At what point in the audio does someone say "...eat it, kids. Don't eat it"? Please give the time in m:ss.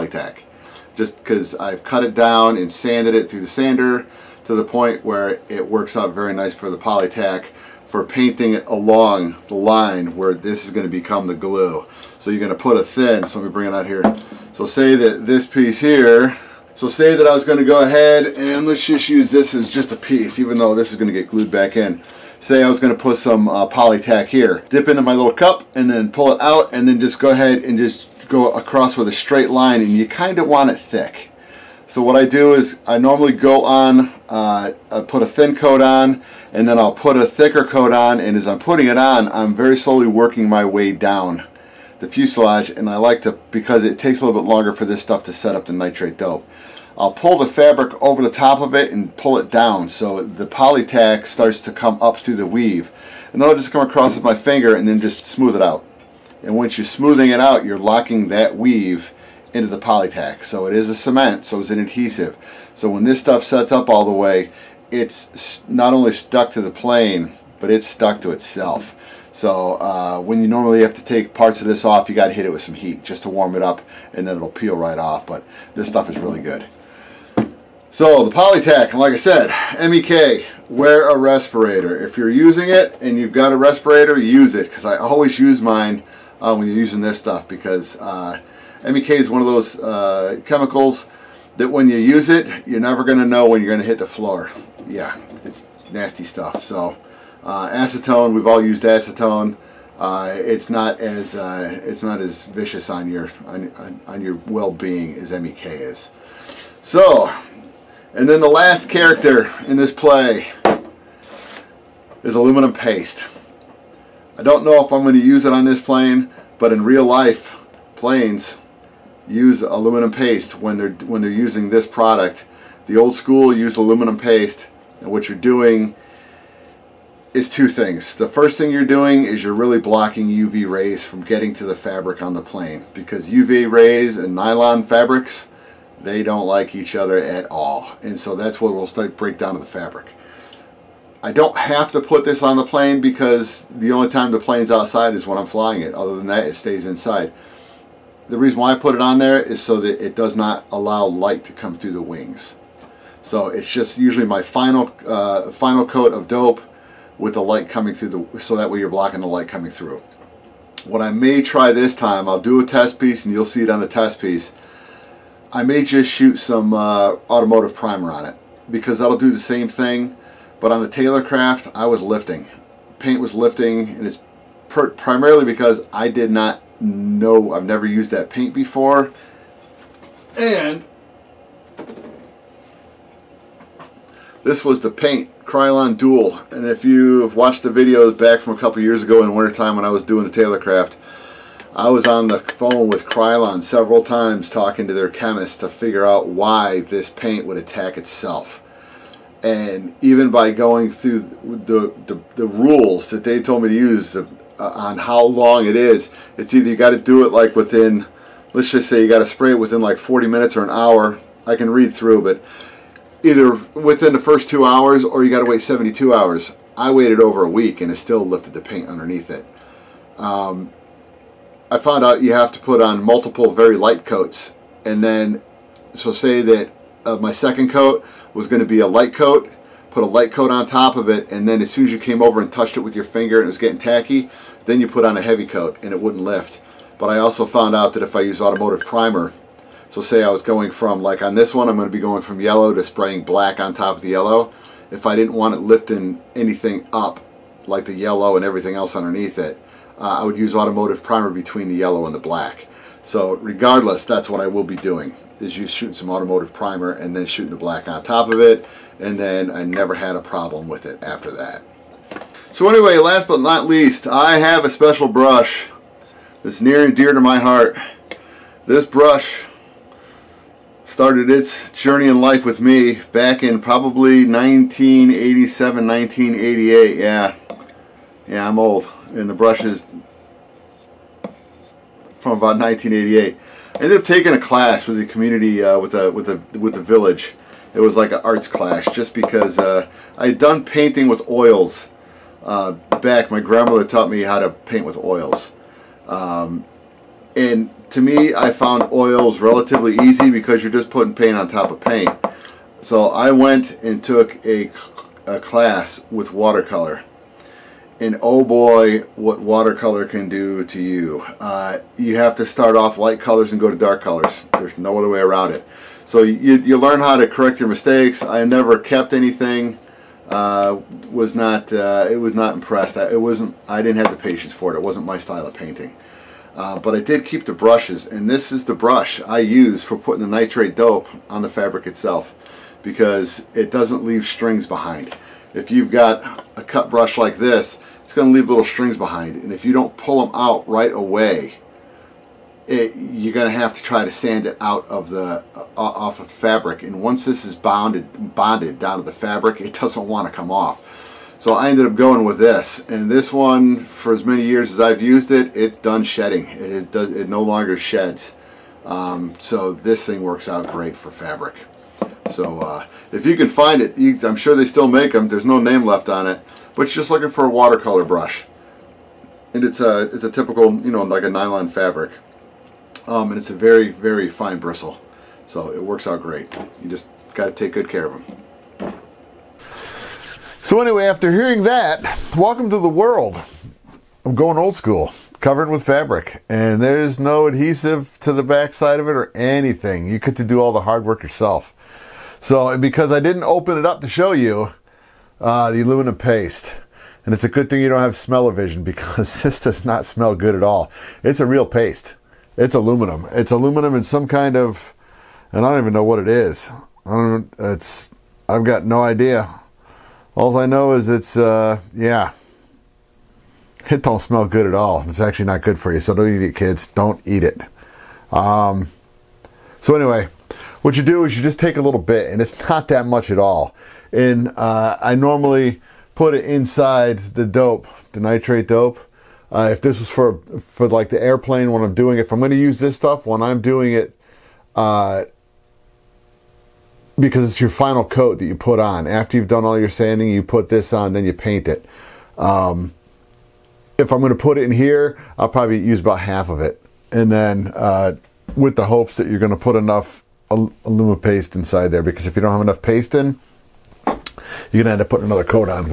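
6:56.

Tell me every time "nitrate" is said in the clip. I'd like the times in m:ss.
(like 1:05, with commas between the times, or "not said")
0:45, 5:30, 7:08.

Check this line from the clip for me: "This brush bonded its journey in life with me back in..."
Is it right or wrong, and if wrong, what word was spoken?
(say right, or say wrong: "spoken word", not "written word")
wrong: "started", not "bonded".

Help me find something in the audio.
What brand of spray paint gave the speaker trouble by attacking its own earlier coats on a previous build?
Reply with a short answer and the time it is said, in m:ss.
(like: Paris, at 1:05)
Krylon Dual, at 3:05.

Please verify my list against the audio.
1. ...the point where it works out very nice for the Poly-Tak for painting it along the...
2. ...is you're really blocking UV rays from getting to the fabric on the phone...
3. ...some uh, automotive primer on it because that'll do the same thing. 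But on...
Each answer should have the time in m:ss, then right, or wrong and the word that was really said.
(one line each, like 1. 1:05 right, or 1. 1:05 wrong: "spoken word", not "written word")
1. 0:04 right
2. 2:09 wrong: "plane", not "phone"
3. 2:46 right.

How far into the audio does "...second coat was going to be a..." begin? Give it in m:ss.
3:47.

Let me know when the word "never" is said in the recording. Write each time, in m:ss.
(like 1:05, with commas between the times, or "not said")
1:32, 2:57, 4:19, 5:18.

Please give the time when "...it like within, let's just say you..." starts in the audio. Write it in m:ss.
3:27.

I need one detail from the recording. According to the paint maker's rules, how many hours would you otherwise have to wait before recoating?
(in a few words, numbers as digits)
72.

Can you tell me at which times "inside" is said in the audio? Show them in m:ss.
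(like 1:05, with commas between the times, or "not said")
2:26, 7:06, 7:31.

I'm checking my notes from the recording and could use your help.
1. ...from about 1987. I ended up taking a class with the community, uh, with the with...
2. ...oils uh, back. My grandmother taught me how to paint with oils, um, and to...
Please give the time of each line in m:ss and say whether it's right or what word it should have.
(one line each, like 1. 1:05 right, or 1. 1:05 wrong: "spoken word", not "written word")
1. 4:42 wrong: "1988", not "1987"
2. 4:51 right.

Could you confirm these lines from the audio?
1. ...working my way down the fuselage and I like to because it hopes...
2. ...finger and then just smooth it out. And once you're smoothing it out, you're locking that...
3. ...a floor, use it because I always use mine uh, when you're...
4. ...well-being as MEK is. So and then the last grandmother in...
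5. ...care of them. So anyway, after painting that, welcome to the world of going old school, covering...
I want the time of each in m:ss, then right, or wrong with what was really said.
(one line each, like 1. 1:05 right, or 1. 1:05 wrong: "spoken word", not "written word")
1. 0:40 wrong: "takes", not "hopes"
2. 0:54 right
3. 1:23 wrong: "respirator", not "floor"
4. 1:44 wrong: "character", not "grandmother"
5. 6:17 wrong: "hearing", not "painting".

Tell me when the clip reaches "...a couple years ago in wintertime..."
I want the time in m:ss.
3:08.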